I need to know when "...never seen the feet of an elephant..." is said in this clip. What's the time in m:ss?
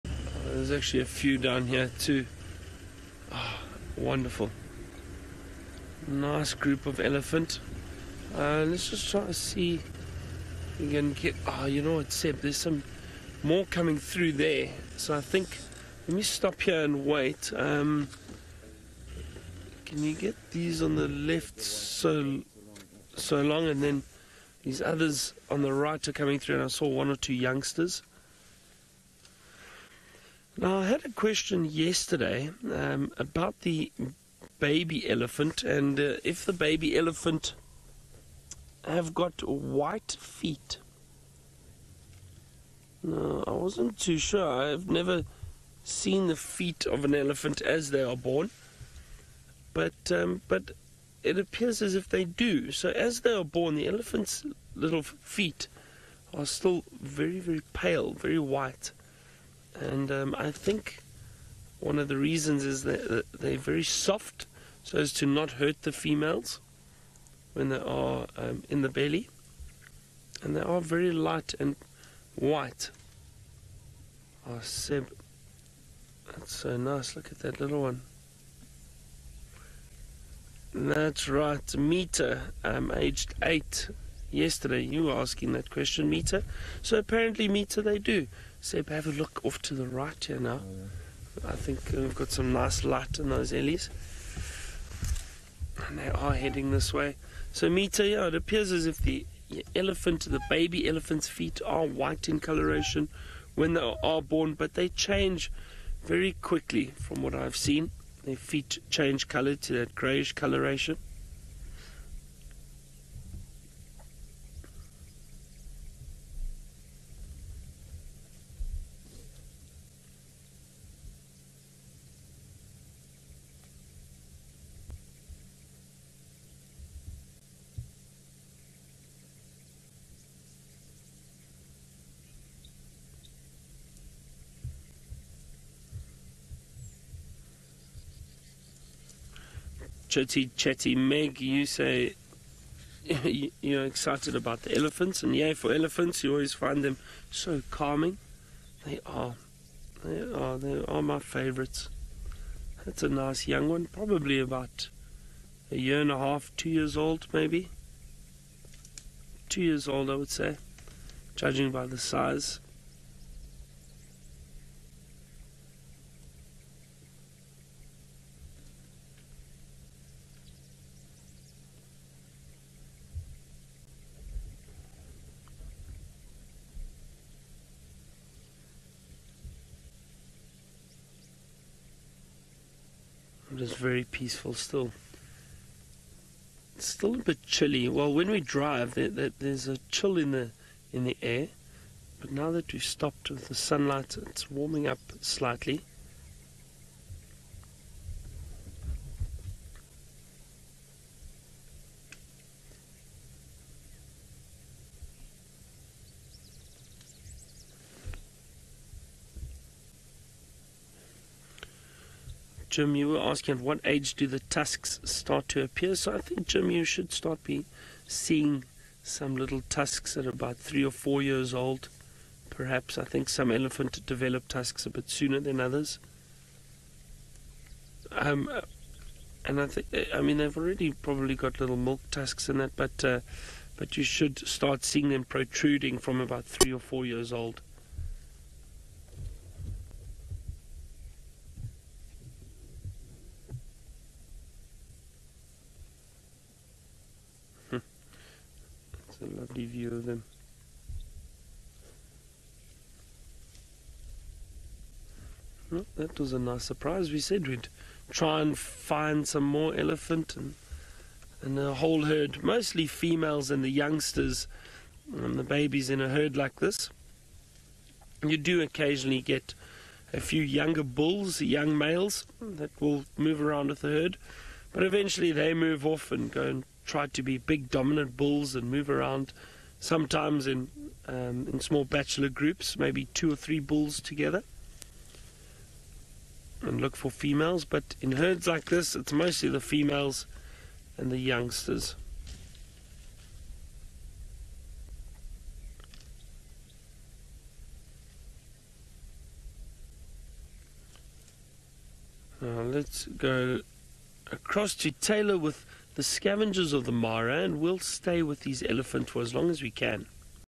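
0:44.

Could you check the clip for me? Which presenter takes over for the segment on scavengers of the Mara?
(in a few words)
Taylor.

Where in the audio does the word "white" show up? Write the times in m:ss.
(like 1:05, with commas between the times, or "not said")
0:39, 0:58, 1:12, 1:41.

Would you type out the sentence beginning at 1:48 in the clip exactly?
Their feet change color to that grayish coloration.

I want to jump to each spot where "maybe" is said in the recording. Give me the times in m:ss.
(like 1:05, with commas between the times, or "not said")
2:37, 4:42.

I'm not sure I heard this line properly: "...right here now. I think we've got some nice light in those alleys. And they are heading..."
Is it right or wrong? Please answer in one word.
right.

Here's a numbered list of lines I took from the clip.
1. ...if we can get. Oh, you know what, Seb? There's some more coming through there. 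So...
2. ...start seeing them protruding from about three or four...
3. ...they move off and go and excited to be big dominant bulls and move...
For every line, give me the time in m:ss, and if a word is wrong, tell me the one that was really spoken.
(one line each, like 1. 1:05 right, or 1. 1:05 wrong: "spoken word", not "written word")
1. 0:09 right
2. 3:54 right
3. 4:35 wrong: "tried", not "excited".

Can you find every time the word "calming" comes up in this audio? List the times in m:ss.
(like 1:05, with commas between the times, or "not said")
2:27.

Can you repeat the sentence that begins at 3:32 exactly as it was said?
Jim, you were asking at what age do the tusks start to appear.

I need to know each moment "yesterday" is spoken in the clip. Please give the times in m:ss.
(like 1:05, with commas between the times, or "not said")
0:31, 1:24.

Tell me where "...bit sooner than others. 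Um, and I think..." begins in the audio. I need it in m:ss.
3:44.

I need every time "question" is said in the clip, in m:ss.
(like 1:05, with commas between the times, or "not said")
0:31, 1:25.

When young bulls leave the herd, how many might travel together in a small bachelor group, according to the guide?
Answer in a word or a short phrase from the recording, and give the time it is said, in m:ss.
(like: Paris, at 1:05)
2 or 3, at 4:43.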